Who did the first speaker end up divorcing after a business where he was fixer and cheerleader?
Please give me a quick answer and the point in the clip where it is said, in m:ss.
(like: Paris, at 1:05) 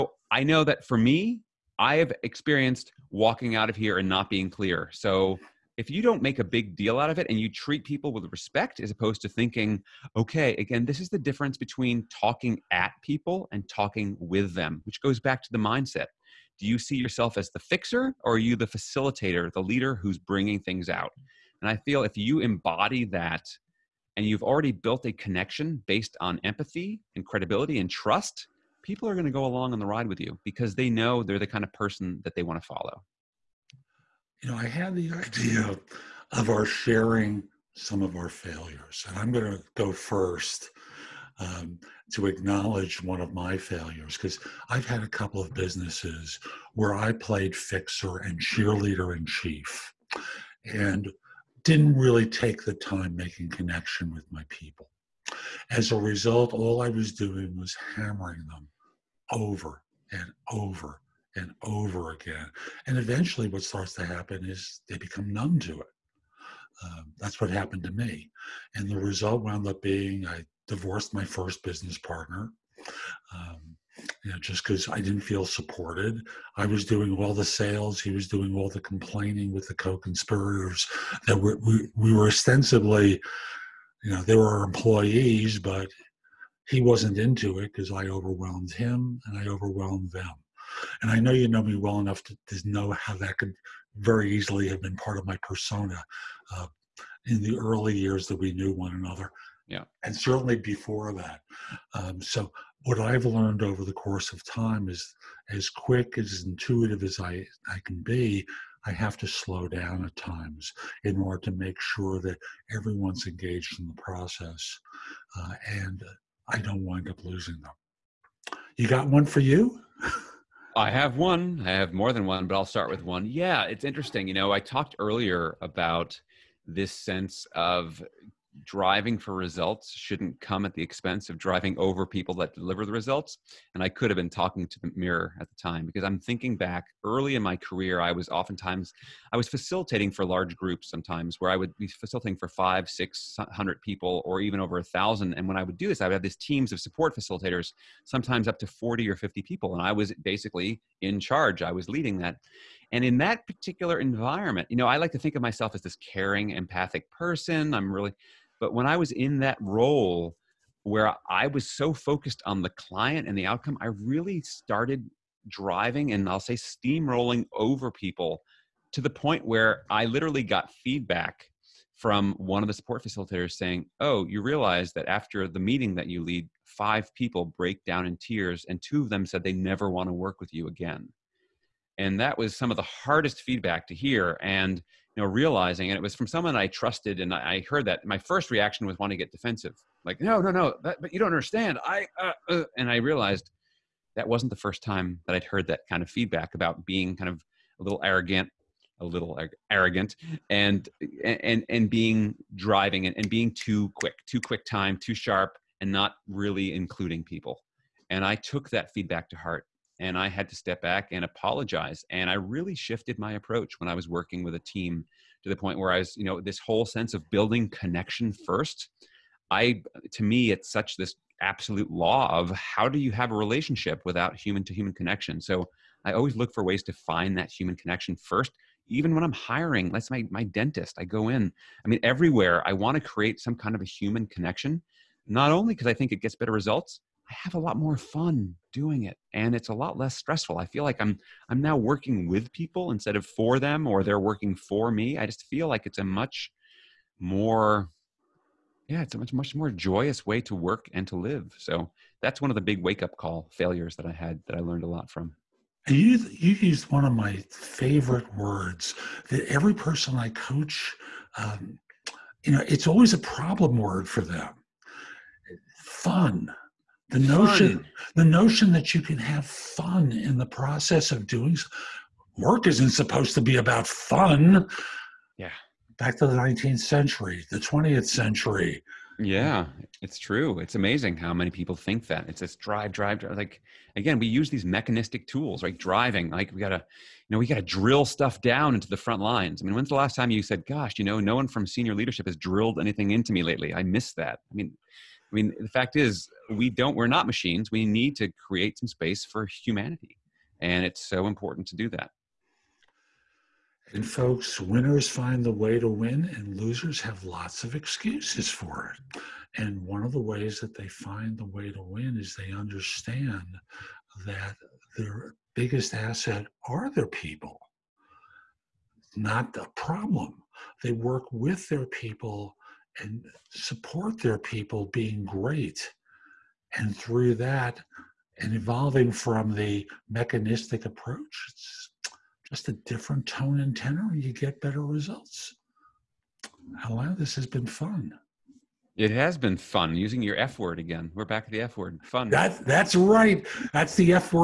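First business partner, at 1:11.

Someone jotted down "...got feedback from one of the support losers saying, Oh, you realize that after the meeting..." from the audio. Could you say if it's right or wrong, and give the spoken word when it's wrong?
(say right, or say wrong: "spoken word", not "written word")
wrong: "facilitators", not "losers".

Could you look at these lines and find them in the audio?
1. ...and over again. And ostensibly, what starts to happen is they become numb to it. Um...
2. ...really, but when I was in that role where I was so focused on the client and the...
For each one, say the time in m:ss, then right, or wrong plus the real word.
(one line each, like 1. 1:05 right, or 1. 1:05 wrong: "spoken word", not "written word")
1. 1:01 wrong: "eventually", not "ostensibly"
2. 2:37 right.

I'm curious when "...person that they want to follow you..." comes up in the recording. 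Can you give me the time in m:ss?
0:31.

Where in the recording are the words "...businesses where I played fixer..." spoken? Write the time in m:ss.
0:45.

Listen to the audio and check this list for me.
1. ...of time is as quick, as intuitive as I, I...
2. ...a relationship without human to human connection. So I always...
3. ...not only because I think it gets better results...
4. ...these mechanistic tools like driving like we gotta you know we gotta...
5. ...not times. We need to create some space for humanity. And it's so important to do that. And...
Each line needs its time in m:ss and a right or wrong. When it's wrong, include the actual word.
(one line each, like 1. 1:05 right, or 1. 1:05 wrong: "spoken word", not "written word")
1. 1:44 right
2. 3:43 right
3. 3:55 right
4. 4:44 right
5. 4:57 wrong: "machines", not "times".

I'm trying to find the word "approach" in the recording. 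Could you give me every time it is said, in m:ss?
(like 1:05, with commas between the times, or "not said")
3:33, 5:30.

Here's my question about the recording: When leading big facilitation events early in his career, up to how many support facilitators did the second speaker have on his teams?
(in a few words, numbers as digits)
40 or 50.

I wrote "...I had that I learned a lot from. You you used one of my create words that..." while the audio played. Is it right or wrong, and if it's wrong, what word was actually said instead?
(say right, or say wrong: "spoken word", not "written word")
wrong: "favorite", not "create".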